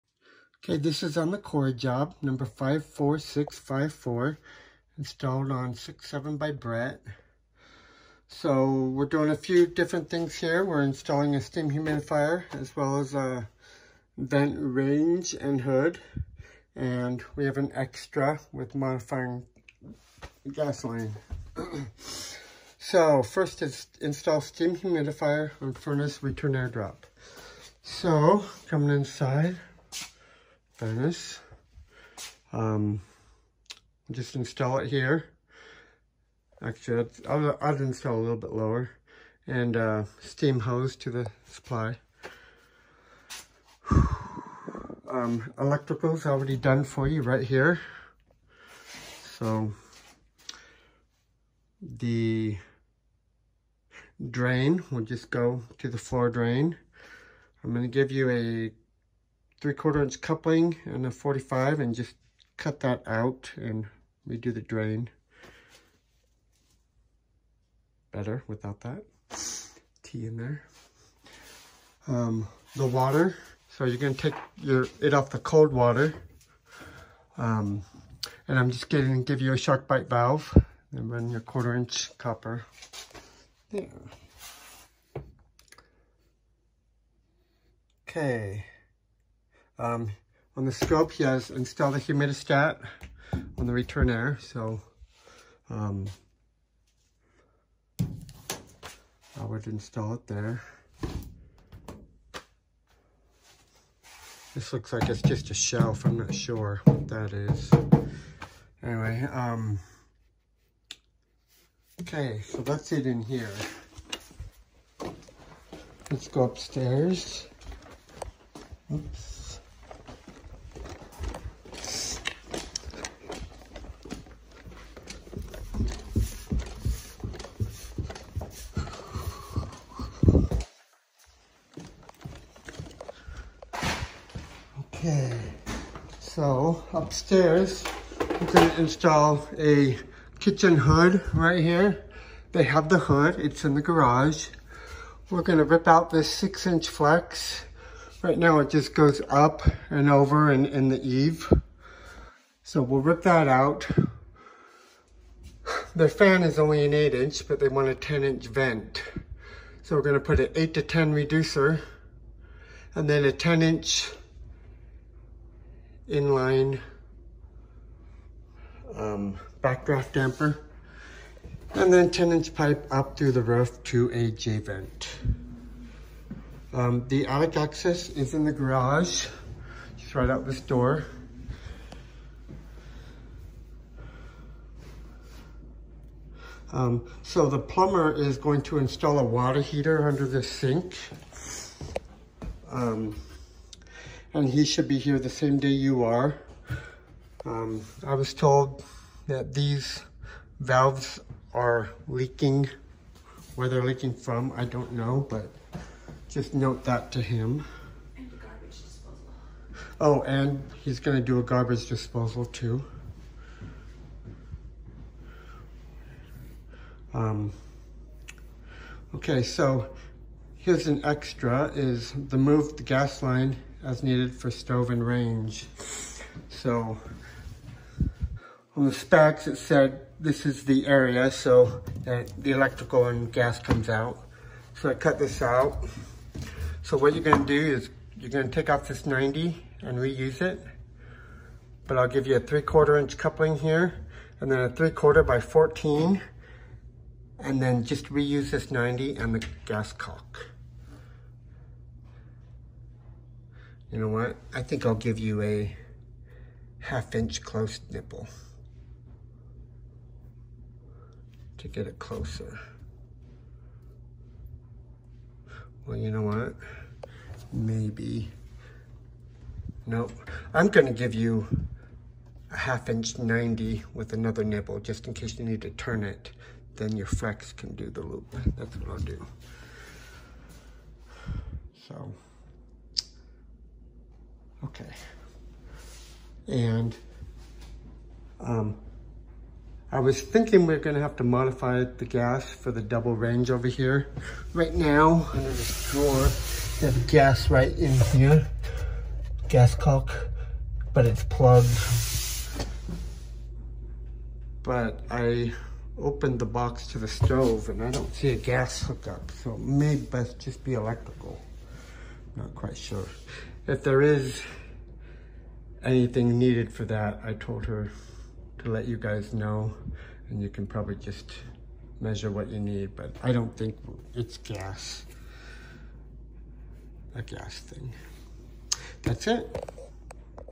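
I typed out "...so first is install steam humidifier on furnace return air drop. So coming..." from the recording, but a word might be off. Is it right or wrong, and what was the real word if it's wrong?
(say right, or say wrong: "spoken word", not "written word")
right.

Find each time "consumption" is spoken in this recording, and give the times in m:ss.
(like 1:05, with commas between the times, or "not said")
not said.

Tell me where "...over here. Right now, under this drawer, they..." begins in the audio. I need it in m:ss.
4:53.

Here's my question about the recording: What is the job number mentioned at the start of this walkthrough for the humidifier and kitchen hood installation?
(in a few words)
54654.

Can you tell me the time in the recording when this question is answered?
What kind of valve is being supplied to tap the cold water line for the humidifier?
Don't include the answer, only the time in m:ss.
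1:19.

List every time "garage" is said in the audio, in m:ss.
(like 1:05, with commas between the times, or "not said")
2:23, 2:58.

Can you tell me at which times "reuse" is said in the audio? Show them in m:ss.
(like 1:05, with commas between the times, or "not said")
3:59, 4:08.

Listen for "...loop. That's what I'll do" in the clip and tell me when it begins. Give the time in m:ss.
4:38.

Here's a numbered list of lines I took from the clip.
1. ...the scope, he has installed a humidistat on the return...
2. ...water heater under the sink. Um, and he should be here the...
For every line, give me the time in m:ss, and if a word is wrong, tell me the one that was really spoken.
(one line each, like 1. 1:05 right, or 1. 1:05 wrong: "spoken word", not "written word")
1. 1:30 right
2. 3:09 right.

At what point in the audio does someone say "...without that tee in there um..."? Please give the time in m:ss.
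1:08.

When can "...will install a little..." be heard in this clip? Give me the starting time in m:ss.
0:37.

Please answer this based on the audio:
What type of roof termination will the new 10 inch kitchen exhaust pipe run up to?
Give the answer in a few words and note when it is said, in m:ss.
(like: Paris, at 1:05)
J vent, at 2:54.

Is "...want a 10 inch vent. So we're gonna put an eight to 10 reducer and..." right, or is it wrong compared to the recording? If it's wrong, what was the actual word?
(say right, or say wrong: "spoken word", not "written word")
right.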